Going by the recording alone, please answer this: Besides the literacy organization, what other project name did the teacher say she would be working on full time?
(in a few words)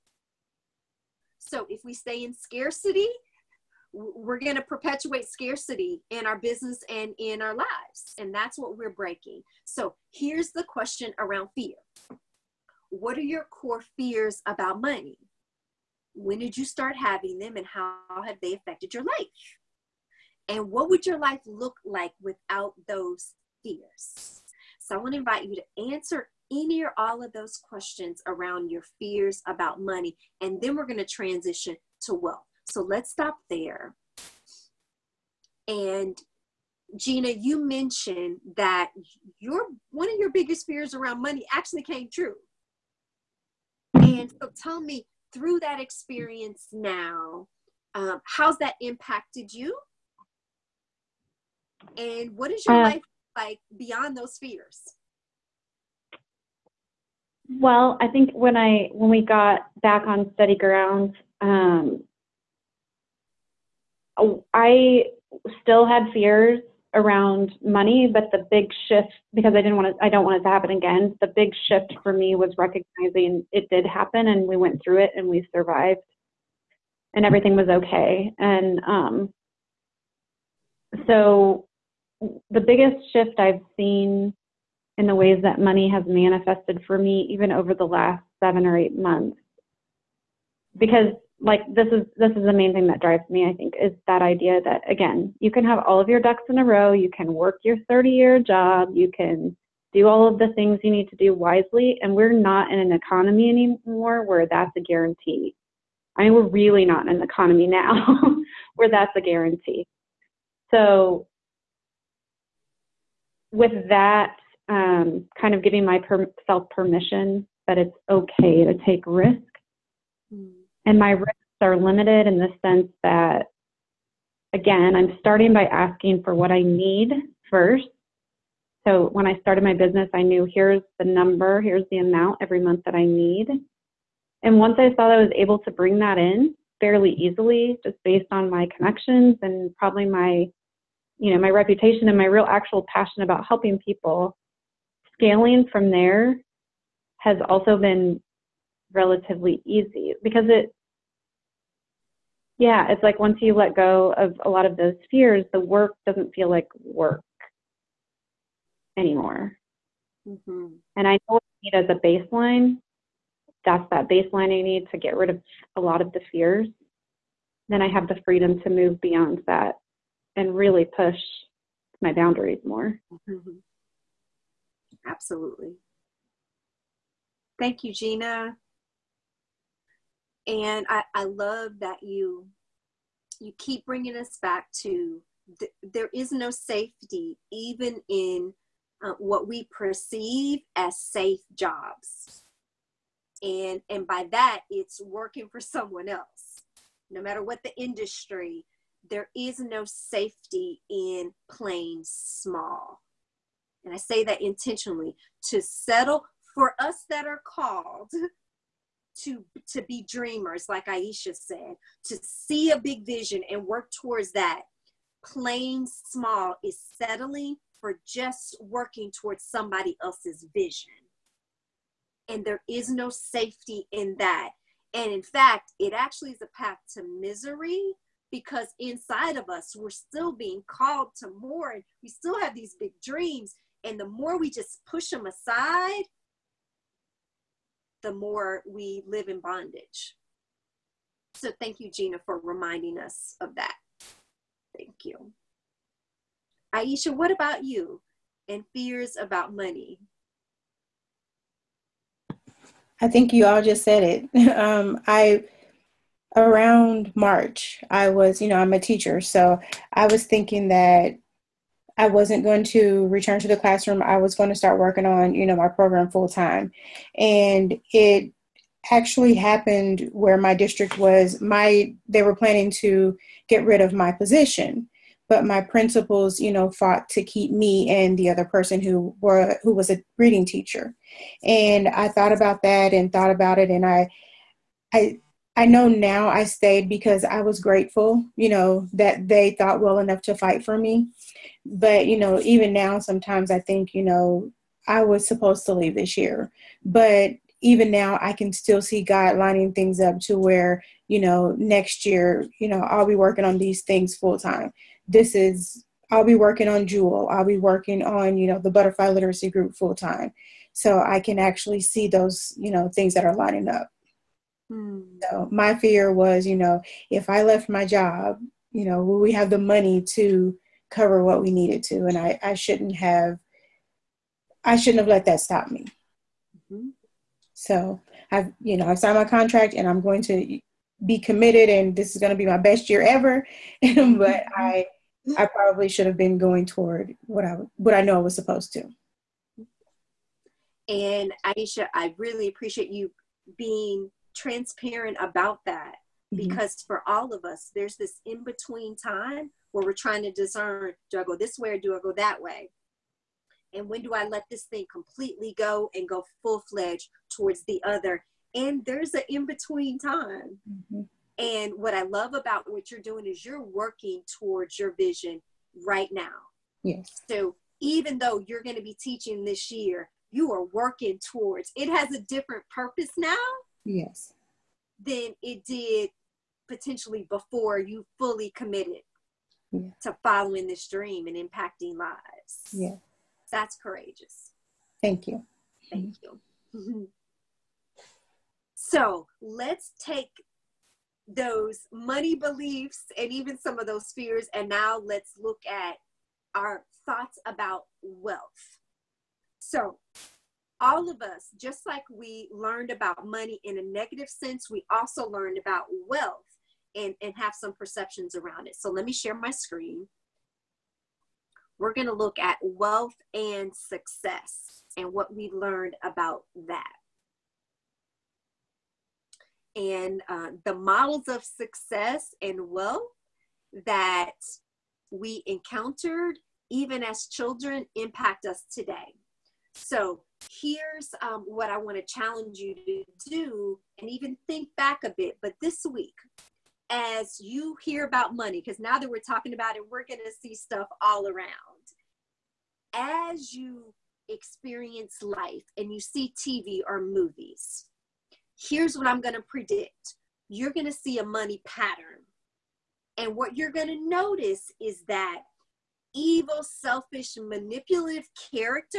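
Jewel.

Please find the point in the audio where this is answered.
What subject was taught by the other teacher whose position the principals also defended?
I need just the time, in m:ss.
4:40.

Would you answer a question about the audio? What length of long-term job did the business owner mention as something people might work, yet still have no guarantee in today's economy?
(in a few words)
30 year job.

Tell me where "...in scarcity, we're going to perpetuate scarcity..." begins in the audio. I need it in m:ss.
0:02.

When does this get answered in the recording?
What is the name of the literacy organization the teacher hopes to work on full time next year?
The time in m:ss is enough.
5:08.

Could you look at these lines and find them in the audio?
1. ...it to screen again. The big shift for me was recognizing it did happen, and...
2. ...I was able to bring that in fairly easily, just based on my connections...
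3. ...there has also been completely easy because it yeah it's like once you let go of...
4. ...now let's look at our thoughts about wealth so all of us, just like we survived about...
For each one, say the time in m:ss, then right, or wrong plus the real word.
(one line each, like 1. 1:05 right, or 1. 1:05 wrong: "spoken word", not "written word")
1. 1:10 wrong: "happen", not "screen"
2. 2:15 right
3. 2:25 wrong: "relatively", not "completely"
4. 6:34 wrong: "learned", not "survived".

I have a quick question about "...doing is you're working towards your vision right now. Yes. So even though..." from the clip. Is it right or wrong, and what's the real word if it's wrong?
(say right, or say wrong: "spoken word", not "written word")
right.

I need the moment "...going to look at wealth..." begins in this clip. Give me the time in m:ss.
6:51.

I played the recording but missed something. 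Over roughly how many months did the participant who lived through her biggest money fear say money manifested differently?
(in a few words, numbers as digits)
7 or 8 months.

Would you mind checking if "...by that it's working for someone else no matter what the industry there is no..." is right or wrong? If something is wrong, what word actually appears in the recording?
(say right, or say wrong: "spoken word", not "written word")
right.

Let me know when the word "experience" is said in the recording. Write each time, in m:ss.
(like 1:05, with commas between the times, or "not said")
0:45, 7:24.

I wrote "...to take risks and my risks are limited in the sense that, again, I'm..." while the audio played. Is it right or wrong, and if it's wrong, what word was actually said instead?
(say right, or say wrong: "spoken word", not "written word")
right.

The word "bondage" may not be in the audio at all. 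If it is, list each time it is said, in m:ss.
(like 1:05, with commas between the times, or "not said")
3:59.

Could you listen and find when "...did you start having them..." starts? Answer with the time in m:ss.
0:16.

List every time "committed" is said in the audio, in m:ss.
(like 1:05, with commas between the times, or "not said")
5:31, 6:18.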